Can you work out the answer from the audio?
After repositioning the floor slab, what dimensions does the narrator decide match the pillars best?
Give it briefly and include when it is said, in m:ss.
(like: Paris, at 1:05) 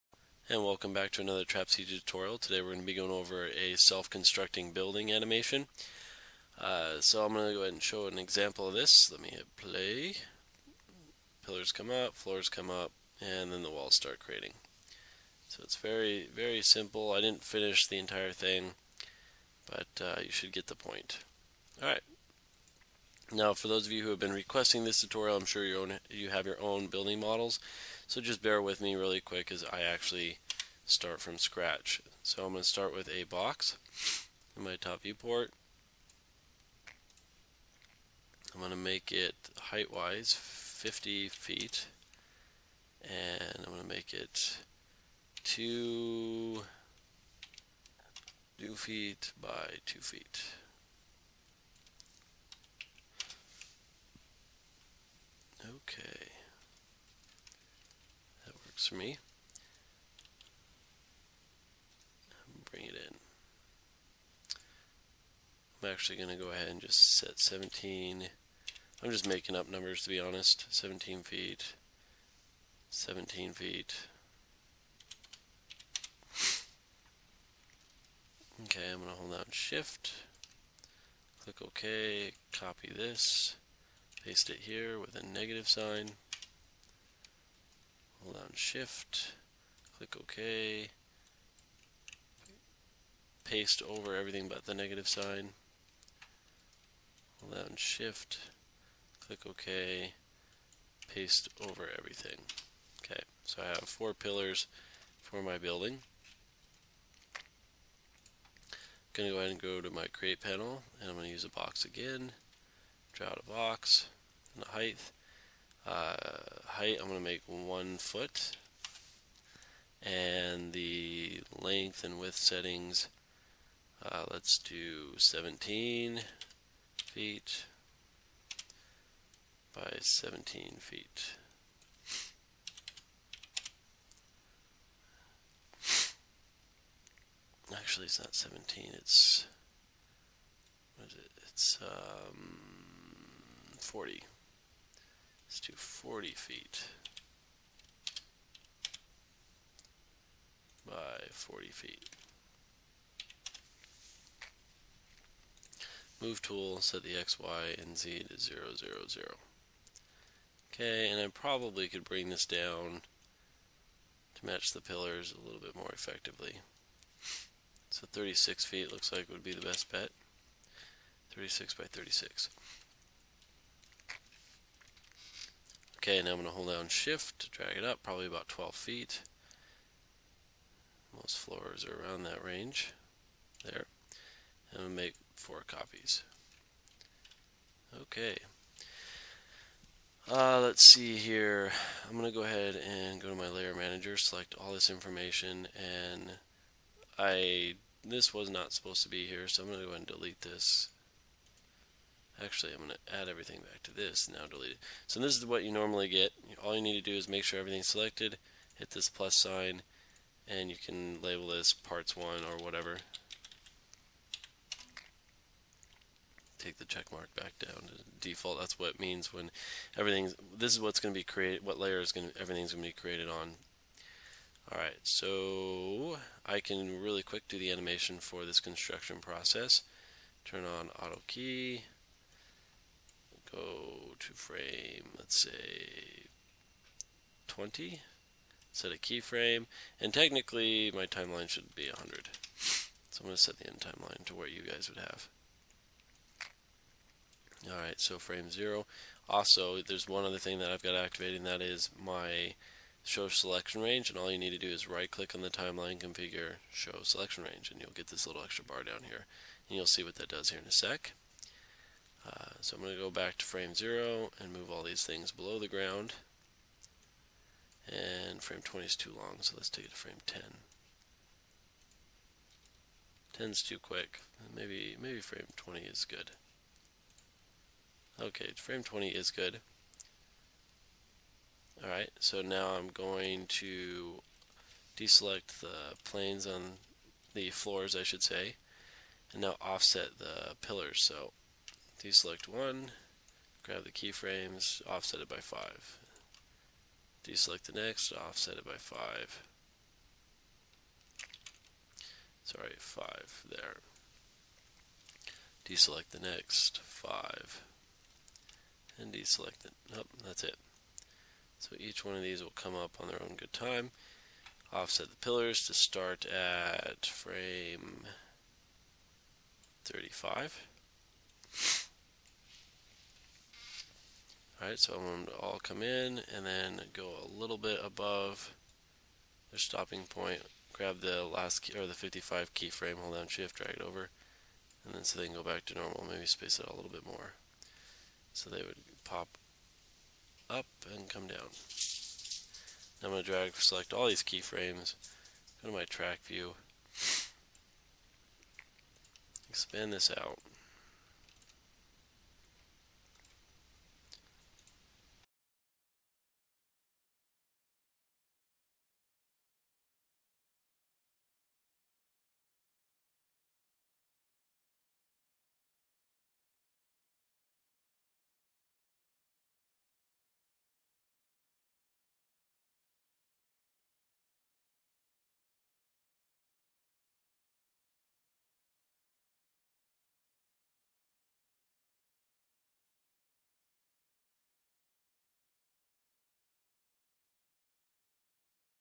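36 by 36, at 2:51.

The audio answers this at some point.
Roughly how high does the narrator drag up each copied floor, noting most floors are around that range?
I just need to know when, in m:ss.
2:58.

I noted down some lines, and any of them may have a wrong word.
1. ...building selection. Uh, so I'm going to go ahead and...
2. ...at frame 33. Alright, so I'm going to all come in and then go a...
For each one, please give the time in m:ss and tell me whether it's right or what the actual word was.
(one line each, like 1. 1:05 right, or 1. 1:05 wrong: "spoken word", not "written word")
1. 0:04 wrong: "animation", not "selection"
2. 5:16 wrong: "35", not "33".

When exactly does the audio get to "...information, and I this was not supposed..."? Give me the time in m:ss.
3:14.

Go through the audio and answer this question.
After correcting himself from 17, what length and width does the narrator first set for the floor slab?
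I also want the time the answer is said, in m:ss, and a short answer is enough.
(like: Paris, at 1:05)
40 feet by 40 feet, at 2:25.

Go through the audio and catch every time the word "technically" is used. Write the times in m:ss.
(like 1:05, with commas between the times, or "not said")
4:00.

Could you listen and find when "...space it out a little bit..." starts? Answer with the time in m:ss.
5:36.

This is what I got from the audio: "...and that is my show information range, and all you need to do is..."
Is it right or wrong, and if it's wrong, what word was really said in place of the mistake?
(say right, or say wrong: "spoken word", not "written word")
wrong: "selection", not "information".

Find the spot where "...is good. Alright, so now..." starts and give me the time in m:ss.
4:39.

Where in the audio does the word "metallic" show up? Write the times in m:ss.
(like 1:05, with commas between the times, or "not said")
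not said.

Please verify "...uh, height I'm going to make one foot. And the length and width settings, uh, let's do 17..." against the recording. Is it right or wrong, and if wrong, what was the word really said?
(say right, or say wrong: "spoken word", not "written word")
right.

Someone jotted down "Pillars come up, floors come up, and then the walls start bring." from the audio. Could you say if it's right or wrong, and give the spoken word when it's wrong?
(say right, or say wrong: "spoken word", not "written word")
wrong: "creating", not "bring".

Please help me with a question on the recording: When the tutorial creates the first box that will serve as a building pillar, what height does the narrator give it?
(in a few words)
50 feet.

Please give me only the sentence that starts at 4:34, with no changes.
Maybe, maybe frame 20 is good.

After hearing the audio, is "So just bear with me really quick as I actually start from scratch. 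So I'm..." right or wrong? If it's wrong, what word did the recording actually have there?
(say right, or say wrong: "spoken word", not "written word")
right.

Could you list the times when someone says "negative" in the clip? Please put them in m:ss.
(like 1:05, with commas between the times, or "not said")
1:25, 1:34.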